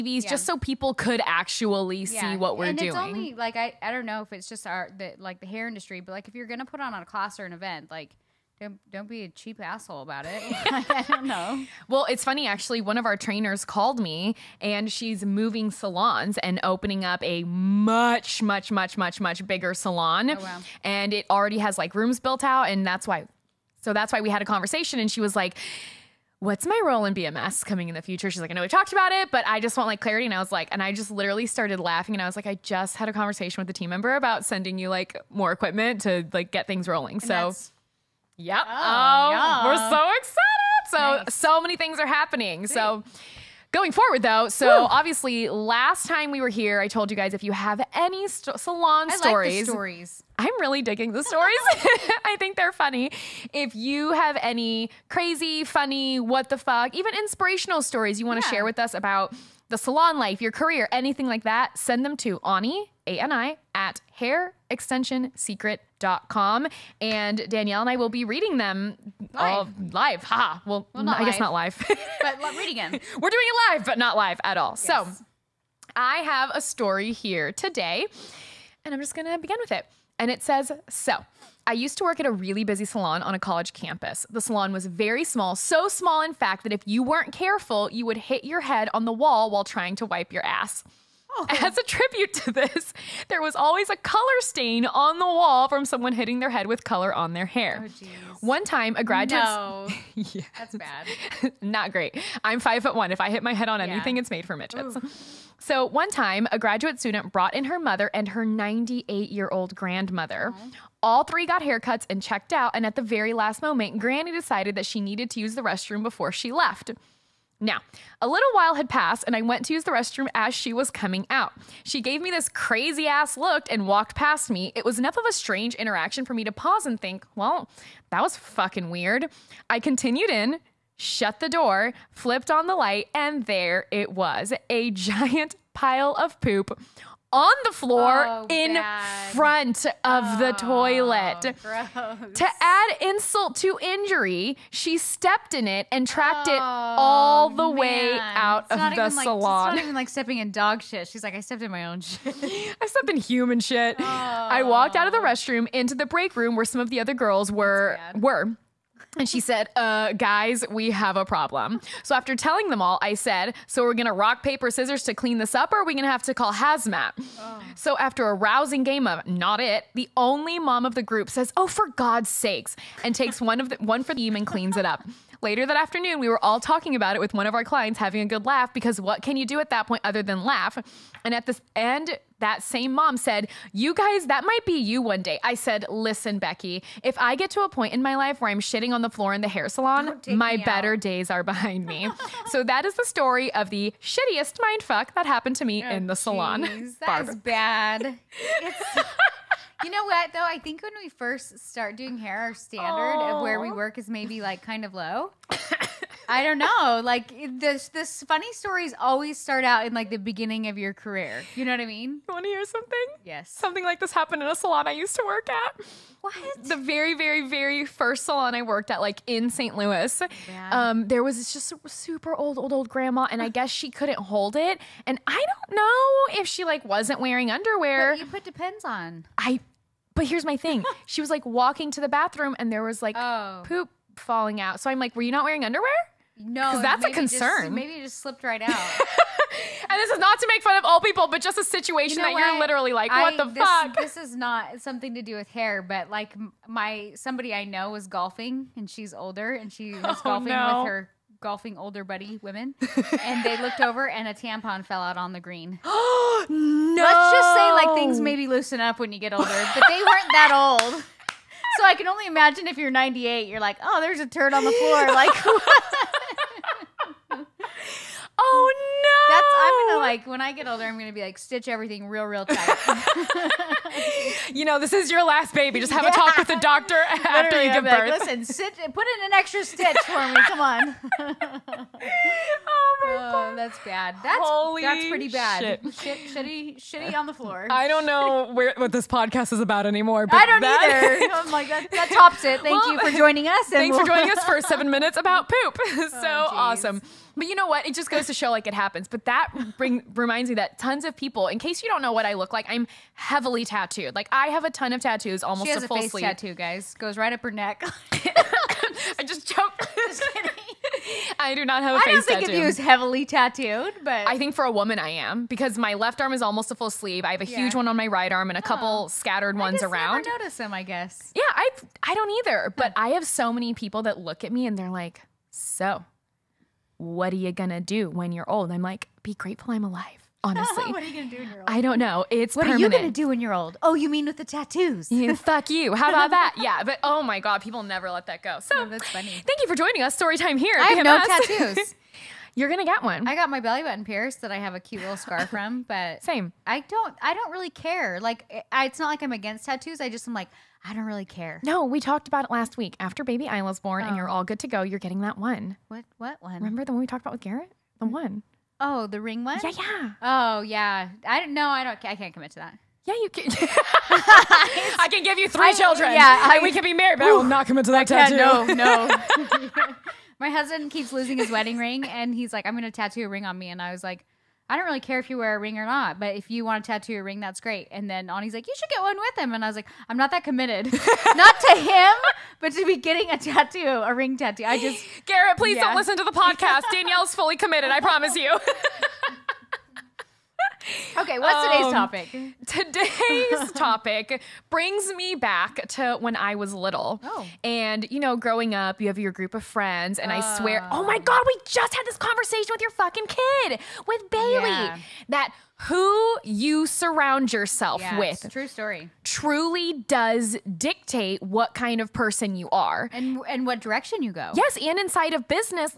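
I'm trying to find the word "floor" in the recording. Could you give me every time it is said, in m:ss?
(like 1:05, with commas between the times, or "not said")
2:17, 3:09, 4:24, 4:47.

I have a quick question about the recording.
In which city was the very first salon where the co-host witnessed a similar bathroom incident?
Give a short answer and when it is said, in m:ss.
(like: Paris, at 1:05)
St. Louis, at 3:39.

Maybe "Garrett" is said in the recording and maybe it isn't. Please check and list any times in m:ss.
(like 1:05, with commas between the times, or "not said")
5:57, 6:25.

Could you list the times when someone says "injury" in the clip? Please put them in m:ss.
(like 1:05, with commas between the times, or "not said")
2:23.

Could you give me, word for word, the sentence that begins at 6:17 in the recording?
And then Ani's like, you should get one with him.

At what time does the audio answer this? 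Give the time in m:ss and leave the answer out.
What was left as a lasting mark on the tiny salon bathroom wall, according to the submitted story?
1:33.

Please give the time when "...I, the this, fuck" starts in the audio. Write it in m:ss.
4:03.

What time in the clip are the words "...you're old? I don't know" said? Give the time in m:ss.
5:31.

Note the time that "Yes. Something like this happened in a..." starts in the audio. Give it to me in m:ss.
3:33.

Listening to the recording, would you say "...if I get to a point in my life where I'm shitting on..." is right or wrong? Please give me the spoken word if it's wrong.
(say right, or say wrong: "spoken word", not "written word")
right.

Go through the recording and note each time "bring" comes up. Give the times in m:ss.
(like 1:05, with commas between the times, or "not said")
4:59, 6:34.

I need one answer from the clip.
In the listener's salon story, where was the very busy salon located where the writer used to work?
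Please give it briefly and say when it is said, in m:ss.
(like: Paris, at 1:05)
college campus, at 1:23.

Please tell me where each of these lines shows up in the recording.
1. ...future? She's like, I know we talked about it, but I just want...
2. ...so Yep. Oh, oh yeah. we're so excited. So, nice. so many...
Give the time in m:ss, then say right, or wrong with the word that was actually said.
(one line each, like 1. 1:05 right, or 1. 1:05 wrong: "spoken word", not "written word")
1. 0:28 right
2. 0:37 right.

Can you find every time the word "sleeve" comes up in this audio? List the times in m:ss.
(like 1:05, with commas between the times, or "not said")
5:06, 5:16.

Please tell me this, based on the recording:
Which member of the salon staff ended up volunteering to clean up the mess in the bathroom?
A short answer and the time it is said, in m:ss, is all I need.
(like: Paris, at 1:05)
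the only mom, at 2:49.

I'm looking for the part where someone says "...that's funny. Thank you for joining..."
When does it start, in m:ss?
5:38.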